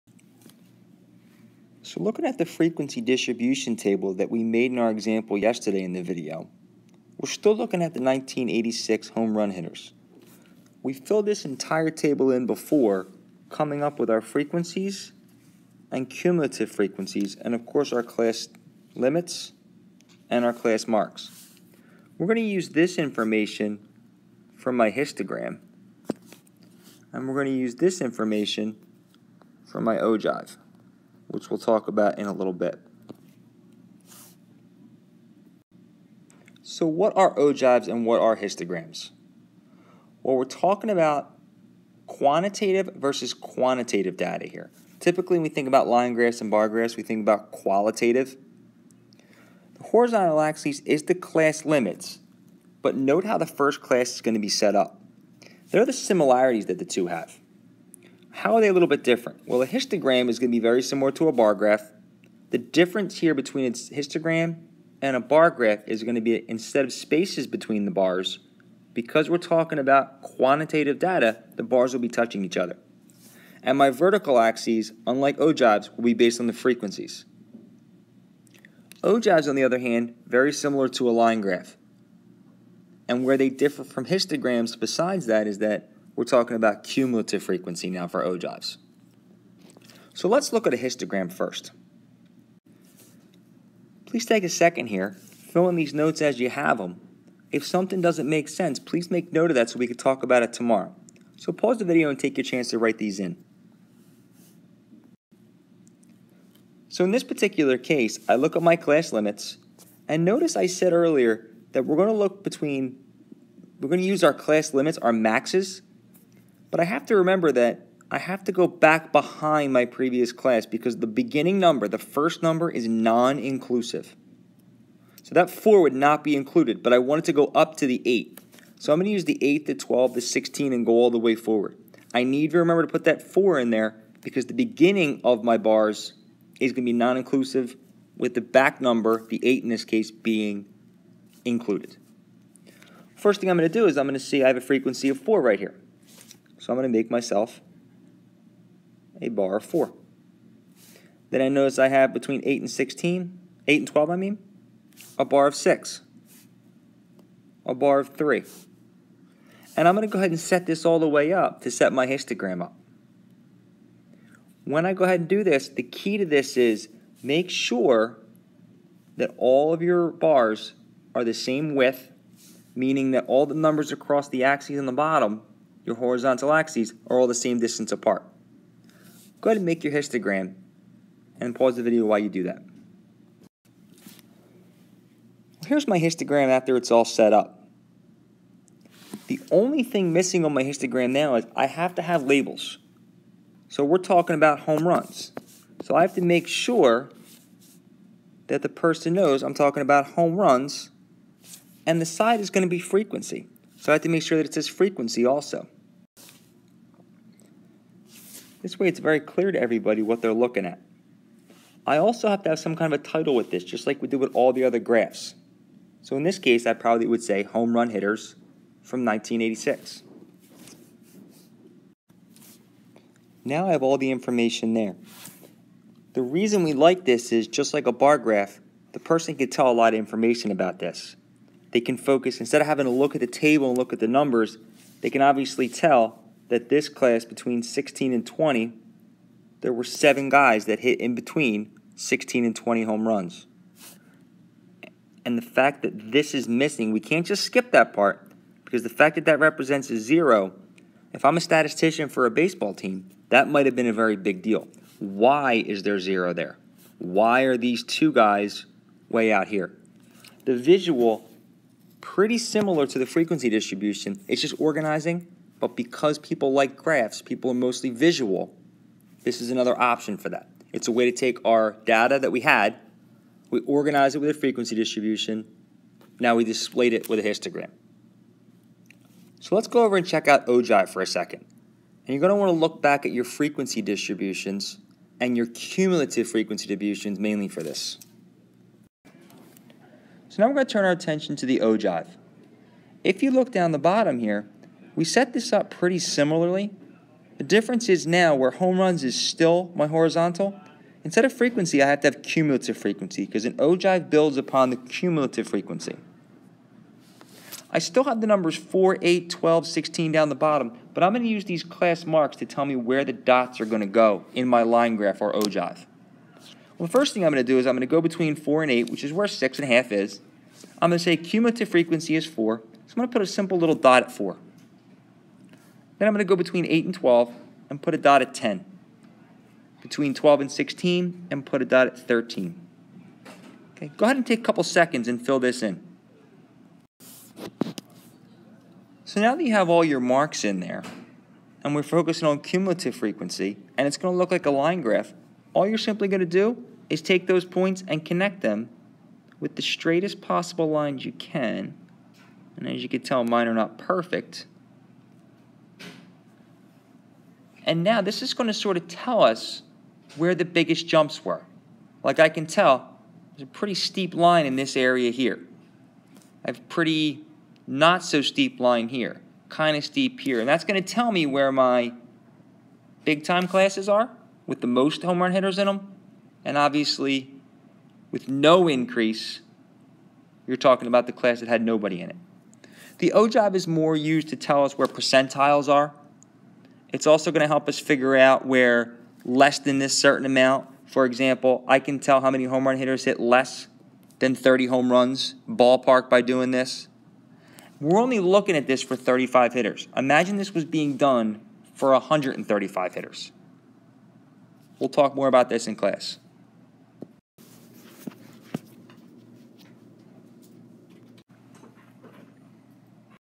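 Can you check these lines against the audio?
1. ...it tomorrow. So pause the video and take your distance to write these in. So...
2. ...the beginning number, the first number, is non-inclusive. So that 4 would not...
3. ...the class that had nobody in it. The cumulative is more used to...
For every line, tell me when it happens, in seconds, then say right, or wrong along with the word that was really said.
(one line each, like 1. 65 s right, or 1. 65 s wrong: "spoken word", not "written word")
1. 100 s wrong: "chance", not "distance"
2. 120 s right
3. 381 s wrong: "ogive", not "cumulative".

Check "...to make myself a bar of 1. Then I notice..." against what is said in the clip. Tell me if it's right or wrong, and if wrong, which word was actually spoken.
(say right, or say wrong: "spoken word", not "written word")
wrong: "4", not "1".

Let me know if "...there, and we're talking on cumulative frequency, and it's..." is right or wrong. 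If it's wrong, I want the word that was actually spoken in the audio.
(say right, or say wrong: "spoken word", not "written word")
wrong: "focusing", not "talking".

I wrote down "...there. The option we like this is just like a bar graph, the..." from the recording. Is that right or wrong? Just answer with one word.
wrong.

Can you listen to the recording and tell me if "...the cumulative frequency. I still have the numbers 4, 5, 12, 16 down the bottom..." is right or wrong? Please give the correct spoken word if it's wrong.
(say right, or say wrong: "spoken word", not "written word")
wrong: "8", not "5".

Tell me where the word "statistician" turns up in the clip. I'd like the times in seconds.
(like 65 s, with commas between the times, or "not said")
251 s.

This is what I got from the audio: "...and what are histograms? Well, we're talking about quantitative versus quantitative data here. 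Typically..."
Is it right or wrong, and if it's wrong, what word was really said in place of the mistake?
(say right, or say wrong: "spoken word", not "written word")
right.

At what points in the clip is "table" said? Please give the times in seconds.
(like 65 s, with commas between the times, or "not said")
3 s, 11 s, 233 s.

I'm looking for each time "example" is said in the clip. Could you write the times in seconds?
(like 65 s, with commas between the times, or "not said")
4 s, 391 s.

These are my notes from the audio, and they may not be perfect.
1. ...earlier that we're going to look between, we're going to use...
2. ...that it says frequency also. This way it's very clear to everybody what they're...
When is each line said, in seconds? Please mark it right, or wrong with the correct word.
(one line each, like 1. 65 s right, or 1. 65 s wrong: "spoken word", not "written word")
1. 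110 s right
2. 204 s right.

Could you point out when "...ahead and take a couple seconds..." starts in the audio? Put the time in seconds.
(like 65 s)
334 s.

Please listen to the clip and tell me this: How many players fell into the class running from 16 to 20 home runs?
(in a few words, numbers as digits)
7.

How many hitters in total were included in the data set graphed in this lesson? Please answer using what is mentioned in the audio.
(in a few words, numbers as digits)
35.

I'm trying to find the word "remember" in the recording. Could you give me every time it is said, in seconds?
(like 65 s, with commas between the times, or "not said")
117 s, 132 s.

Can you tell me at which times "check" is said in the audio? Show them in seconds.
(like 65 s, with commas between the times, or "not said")
280 s.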